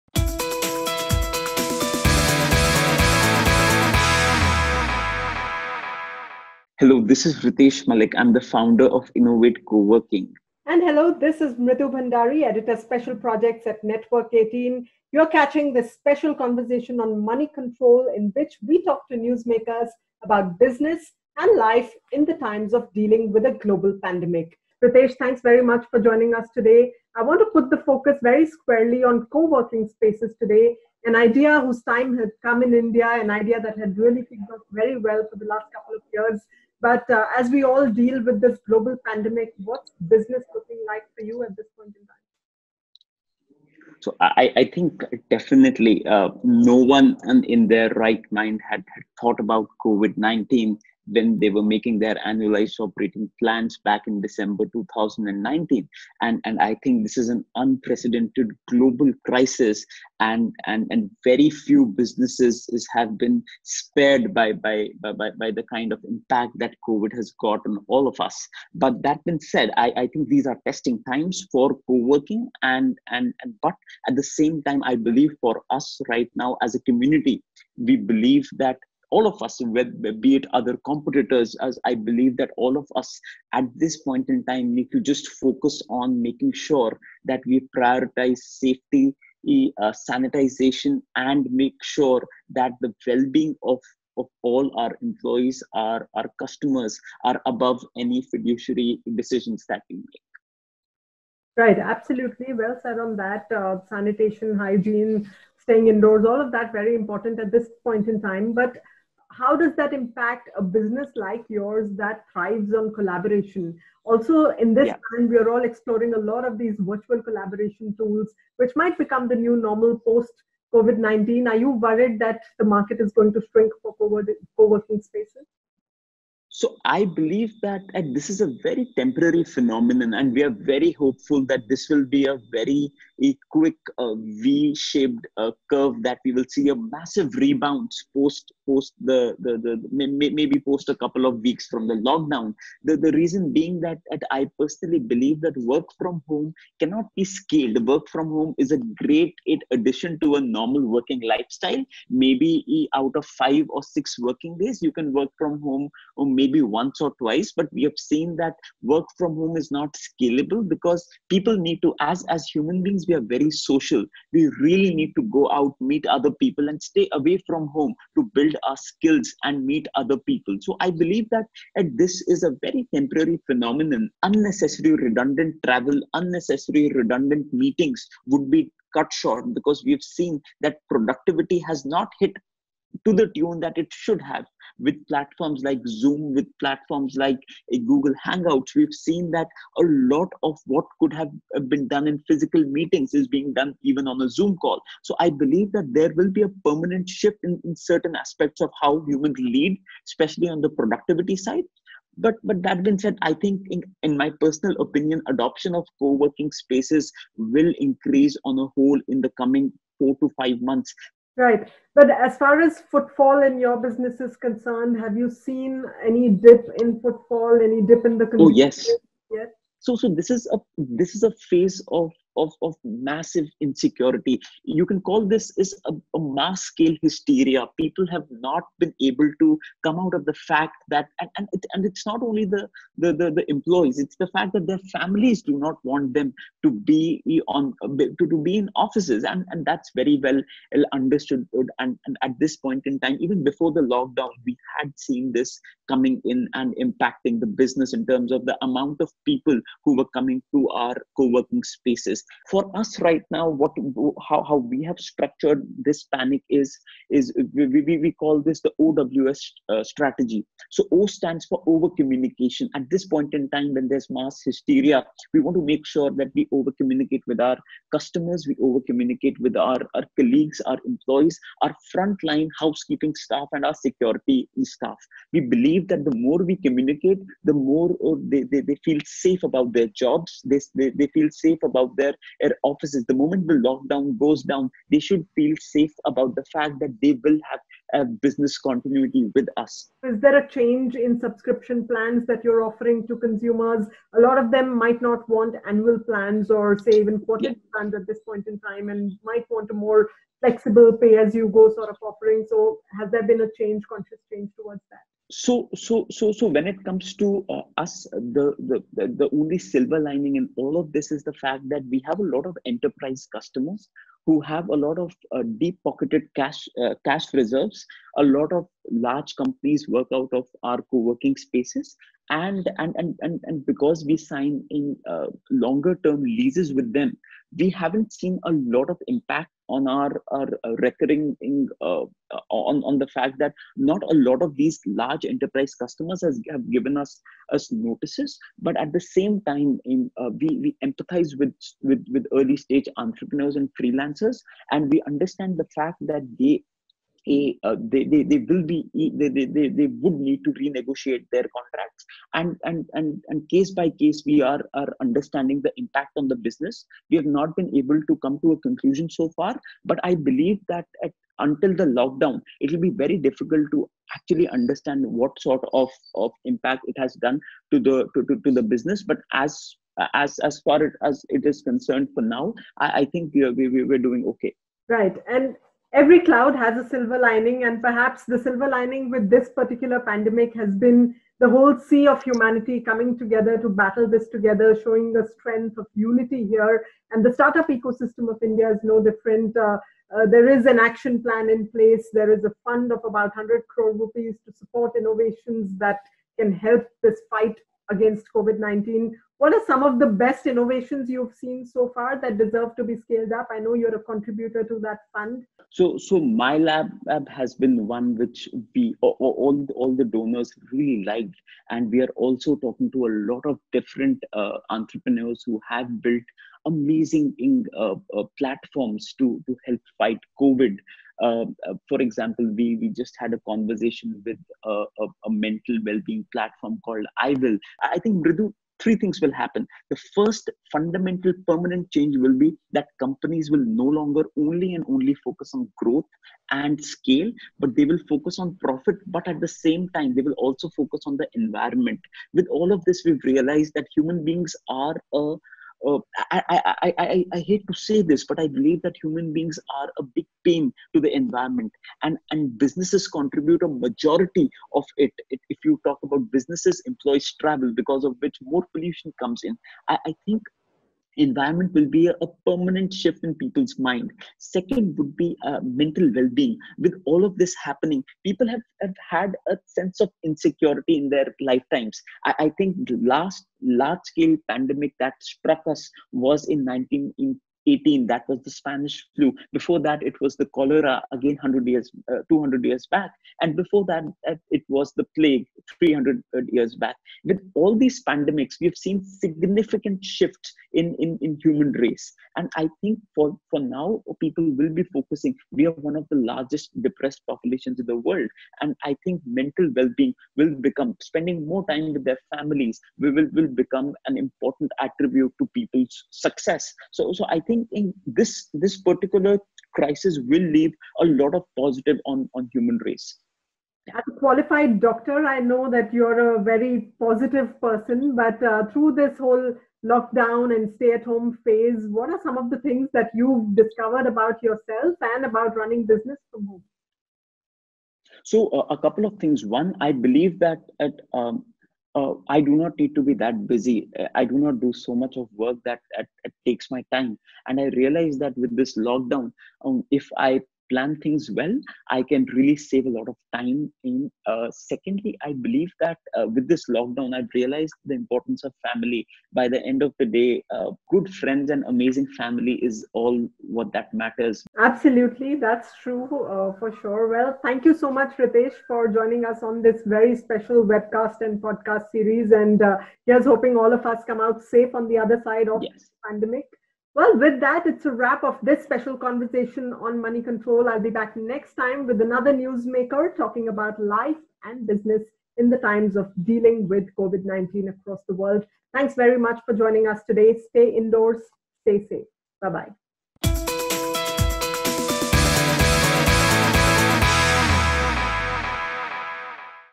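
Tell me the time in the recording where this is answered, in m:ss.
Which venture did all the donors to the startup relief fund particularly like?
6:46.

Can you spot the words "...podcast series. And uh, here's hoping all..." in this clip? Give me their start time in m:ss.
9:21.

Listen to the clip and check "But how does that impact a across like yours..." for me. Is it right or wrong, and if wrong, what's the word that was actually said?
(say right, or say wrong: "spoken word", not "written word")
wrong: "business", not "across".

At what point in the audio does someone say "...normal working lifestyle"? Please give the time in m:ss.
2:30.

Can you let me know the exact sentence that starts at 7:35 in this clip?
it if you talk about businesses, employees travel, because of which more pollution comes in.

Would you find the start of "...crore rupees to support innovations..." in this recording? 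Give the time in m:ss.
6:33.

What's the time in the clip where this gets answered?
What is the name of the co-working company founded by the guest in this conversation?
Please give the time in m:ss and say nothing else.
0:09.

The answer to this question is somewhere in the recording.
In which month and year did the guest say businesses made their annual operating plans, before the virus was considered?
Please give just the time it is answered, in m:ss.
0:54.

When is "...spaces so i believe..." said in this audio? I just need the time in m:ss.
2:05.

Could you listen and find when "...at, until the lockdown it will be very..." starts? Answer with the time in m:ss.
6:01.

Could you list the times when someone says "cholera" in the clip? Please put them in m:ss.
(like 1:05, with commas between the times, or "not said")
8:00.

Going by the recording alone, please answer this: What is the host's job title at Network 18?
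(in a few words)
editor special projects.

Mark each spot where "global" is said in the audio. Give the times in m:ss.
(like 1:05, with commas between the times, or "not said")
0:23, 0:38, 0:58.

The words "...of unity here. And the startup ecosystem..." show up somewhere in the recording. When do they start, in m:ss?
6:25.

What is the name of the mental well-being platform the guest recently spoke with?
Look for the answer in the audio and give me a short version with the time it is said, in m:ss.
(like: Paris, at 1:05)
iWill, at 7:07.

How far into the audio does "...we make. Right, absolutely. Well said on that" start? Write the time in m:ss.
1:39.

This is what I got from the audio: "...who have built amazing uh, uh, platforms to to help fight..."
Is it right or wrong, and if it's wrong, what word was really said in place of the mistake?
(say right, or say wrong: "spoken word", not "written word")
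right.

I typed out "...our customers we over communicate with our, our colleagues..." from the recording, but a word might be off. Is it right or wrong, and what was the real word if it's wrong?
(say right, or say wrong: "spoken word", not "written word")
right.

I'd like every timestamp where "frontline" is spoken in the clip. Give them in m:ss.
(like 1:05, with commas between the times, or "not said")
4:31.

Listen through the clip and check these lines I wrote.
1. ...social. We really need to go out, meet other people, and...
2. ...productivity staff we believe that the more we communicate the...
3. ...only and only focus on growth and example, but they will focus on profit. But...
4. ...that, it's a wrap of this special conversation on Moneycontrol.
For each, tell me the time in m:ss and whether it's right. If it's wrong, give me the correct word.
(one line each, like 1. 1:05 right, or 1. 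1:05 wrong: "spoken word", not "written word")
1. 2:43 right
2. 4:33 wrong: "security", not "productivity"
3. 7:14 wrong: "scale", not "example"
4. 9:27 right.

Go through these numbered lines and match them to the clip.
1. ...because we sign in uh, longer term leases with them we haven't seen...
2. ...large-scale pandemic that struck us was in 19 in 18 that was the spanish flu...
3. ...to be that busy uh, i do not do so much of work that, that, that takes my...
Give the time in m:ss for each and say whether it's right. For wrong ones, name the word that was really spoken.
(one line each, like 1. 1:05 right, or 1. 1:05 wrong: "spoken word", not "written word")
1. 5:23 right
2. 7:53 right
3. 8:52 right.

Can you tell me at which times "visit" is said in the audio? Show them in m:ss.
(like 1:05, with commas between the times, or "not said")
not said.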